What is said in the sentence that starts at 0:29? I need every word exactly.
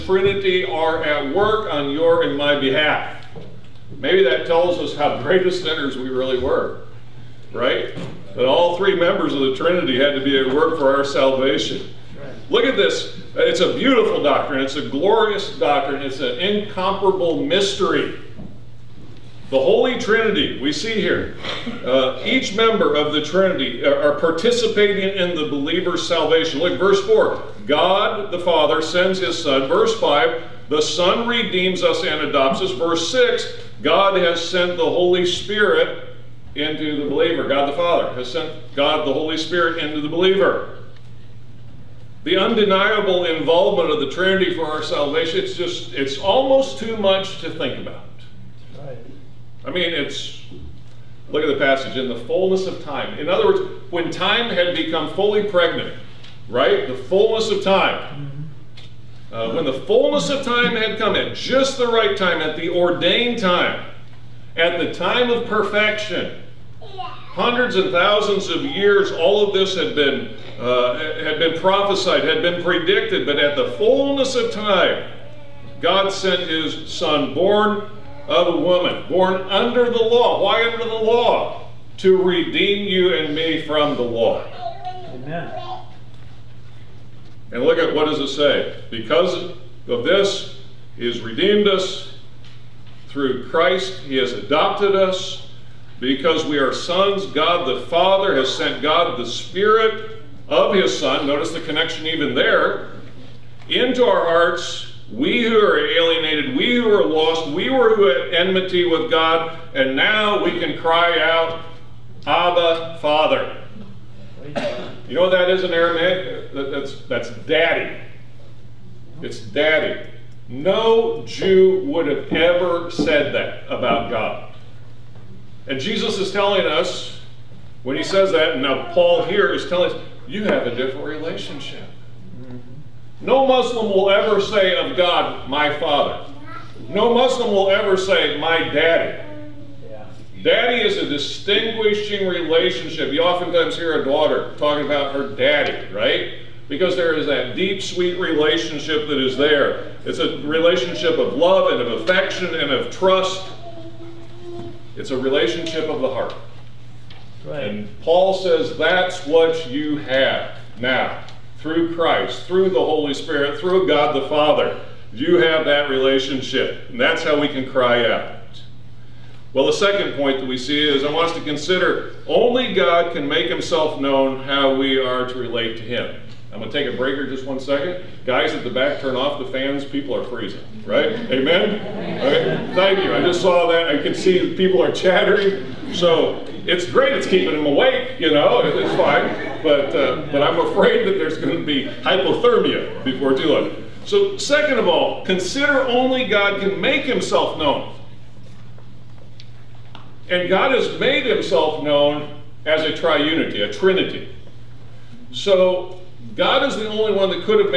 Verse 5 The Son redeems us and adopts us.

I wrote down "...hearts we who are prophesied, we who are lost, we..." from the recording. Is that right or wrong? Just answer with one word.
wrong.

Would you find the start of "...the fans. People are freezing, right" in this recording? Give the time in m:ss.
2:59.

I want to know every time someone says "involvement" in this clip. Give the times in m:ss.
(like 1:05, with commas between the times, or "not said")
0:43.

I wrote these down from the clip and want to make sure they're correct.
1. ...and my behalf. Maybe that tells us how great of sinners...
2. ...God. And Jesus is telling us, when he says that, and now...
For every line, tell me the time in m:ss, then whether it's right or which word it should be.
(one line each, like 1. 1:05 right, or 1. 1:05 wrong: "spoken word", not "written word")
1. 0:02 right
2. 2:04 right.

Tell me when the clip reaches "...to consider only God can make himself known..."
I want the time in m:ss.
2:51.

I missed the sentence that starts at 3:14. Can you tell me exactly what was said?
So, second of all, consider only God can make himself known.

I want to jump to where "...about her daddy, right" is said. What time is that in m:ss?
2:24.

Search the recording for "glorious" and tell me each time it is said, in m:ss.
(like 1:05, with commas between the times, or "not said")
0:14.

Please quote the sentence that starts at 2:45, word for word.
You have that relationship, and that's how we can cry out.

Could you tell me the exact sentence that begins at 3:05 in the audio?
So it's great it's keeping them awake, you know, it's fine.